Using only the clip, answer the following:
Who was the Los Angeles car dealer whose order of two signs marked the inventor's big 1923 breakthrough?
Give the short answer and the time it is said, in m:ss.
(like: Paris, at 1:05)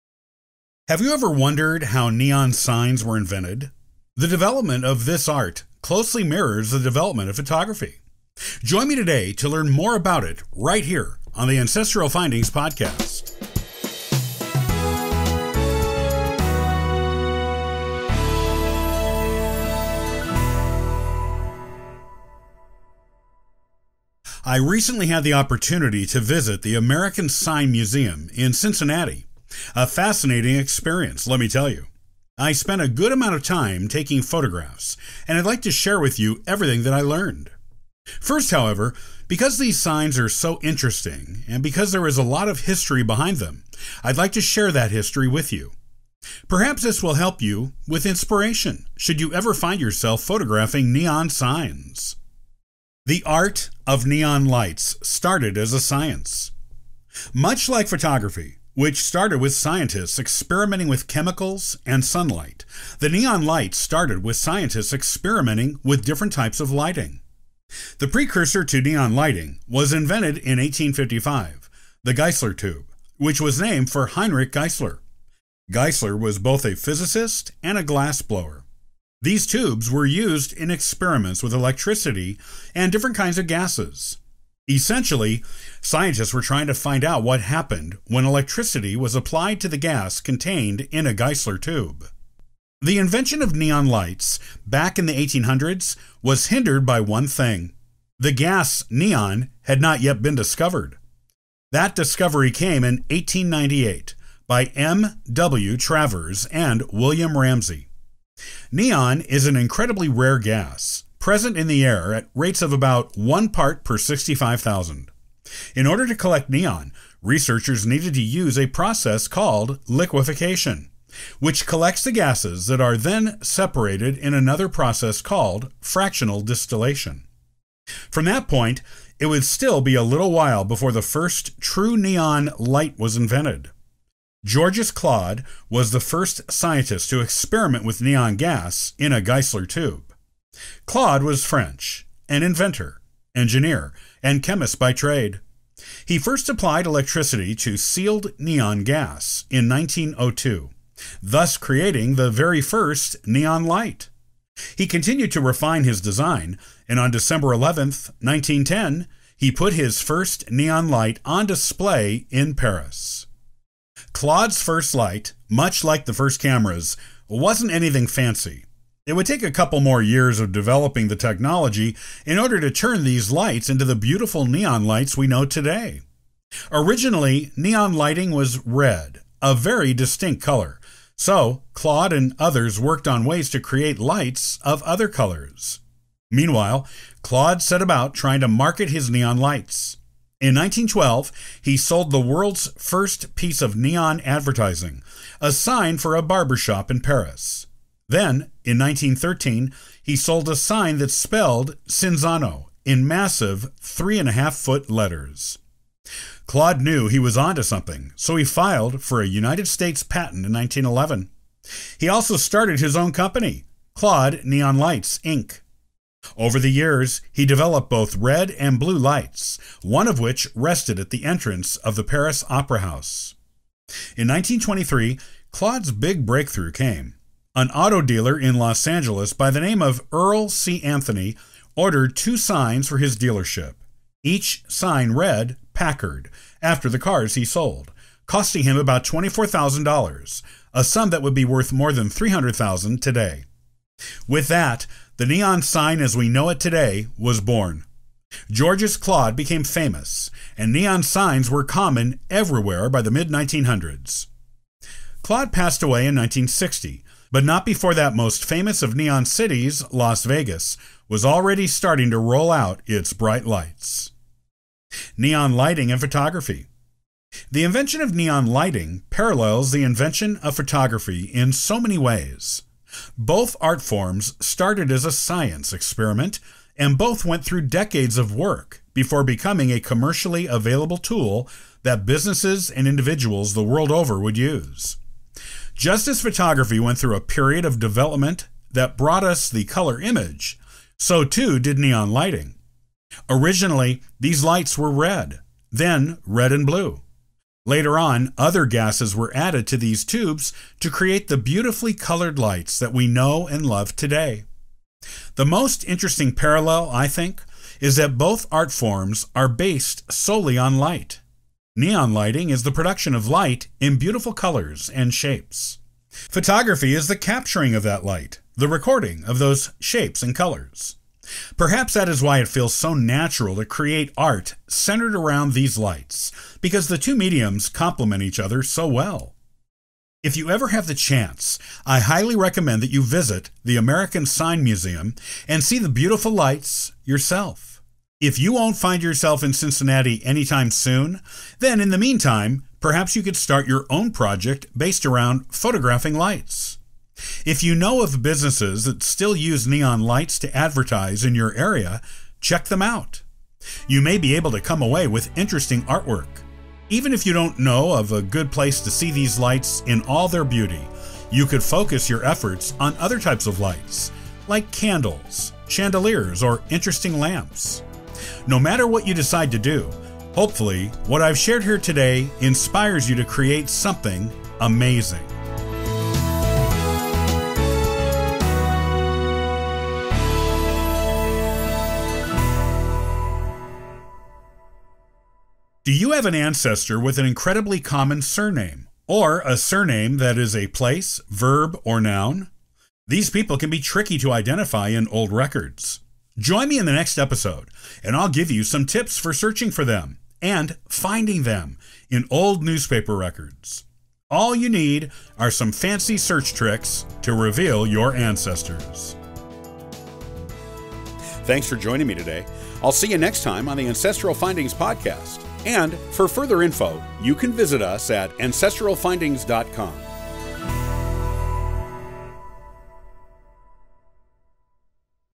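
Earl C. Anthony, at 3:50.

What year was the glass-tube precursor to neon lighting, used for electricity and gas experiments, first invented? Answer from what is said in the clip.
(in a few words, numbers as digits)
1855.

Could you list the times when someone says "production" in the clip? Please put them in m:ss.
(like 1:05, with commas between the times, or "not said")
5:12.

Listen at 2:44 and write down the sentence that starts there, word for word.
Claude's first light, much like the first cameras, wasn't anything fancy.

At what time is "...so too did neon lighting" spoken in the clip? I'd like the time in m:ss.
4:50.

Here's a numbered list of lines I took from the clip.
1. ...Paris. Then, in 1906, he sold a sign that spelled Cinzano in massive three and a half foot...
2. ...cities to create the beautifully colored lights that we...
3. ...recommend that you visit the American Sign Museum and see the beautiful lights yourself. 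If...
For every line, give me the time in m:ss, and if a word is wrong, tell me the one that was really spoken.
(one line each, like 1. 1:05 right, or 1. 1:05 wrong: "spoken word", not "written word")
1. 3:16 wrong: "1913", not "1906"
2. 5:00 wrong: "tubes", not "cities"
3. 5:32 right.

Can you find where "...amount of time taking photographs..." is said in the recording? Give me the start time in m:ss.
0:33.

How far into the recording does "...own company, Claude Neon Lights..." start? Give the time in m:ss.
3:32.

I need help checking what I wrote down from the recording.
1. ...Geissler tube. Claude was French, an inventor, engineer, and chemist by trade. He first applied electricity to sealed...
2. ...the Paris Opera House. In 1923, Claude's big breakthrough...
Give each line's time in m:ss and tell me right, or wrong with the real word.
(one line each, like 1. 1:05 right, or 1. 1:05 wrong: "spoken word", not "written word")
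1. 2:19 right
2. 3:41 right.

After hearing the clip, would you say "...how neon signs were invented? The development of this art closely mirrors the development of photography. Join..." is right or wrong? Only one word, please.
right.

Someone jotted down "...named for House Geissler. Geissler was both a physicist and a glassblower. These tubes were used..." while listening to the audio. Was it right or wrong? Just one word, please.
wrong.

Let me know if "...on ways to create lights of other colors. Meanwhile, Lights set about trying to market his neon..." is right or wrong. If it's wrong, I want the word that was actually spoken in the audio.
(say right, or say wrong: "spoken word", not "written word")
wrong: "Claude", not "Lights".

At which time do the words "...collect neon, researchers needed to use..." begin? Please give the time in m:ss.
1:56.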